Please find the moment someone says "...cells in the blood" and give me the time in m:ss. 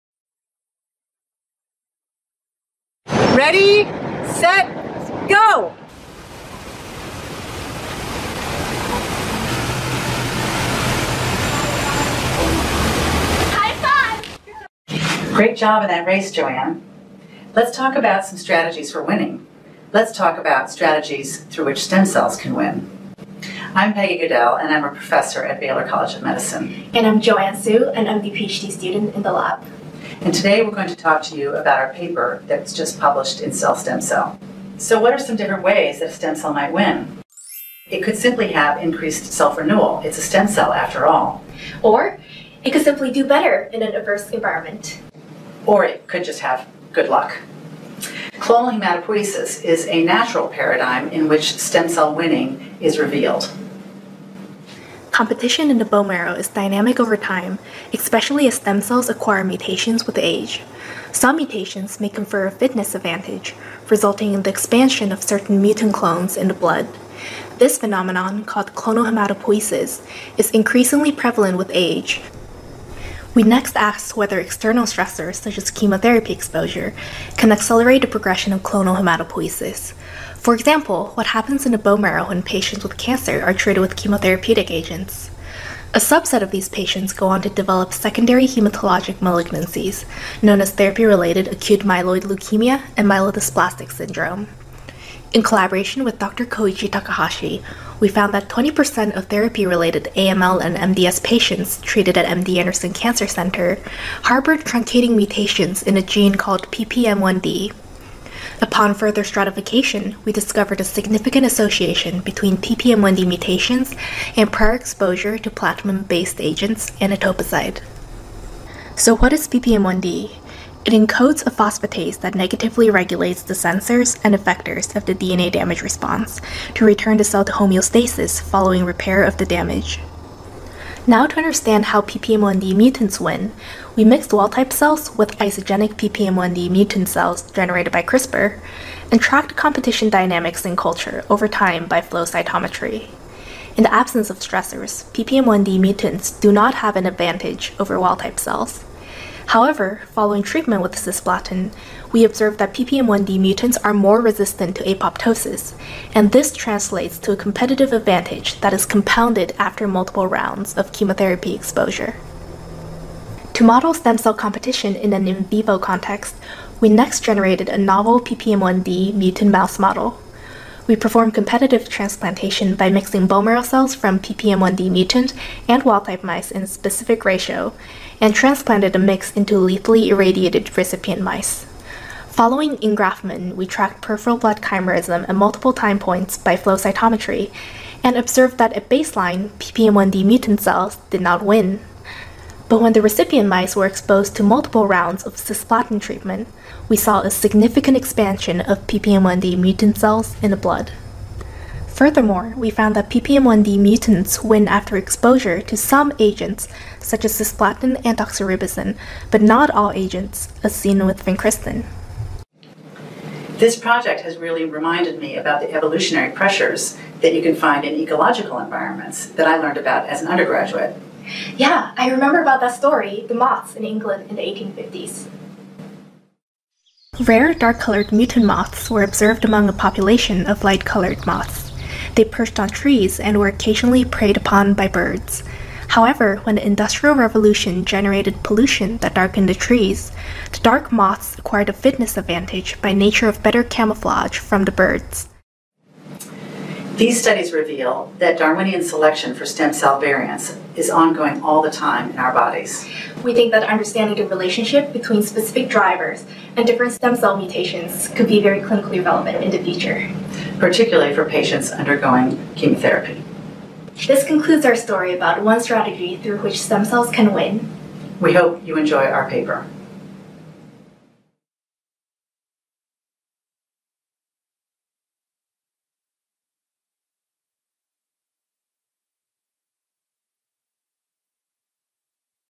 3:19.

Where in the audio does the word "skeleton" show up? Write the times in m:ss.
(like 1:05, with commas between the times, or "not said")
not said.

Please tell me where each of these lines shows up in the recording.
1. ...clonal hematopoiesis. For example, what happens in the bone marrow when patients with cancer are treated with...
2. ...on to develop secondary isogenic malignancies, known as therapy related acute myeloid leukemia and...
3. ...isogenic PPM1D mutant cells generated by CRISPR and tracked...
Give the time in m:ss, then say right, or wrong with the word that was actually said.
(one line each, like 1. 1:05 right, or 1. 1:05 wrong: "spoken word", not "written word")
1. 1:18 right
2. 1:27 wrong: "hematologic", not "isogenic"
3. 2:15 right.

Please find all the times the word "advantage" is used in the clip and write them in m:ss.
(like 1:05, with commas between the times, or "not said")
1:02, 2:27, 2:37, 4:02.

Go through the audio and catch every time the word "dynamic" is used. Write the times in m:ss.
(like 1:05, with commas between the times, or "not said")
0:56, 2:20.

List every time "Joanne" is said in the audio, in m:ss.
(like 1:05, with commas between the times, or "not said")
0:16, 0:27.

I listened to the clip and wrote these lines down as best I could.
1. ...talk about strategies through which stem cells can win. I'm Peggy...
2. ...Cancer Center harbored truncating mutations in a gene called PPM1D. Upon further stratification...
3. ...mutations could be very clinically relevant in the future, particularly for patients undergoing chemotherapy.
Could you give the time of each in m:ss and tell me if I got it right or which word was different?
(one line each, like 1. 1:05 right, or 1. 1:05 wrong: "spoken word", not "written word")
1. 0:20 right
2. 1:42 right
3. 4:17 right.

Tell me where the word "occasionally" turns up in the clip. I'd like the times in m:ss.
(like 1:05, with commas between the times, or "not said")
3:53.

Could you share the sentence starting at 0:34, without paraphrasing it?
So what are some different ways that a stem cell might win?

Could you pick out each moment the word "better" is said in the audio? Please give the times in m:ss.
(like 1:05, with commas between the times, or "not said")
0:43, 4:03.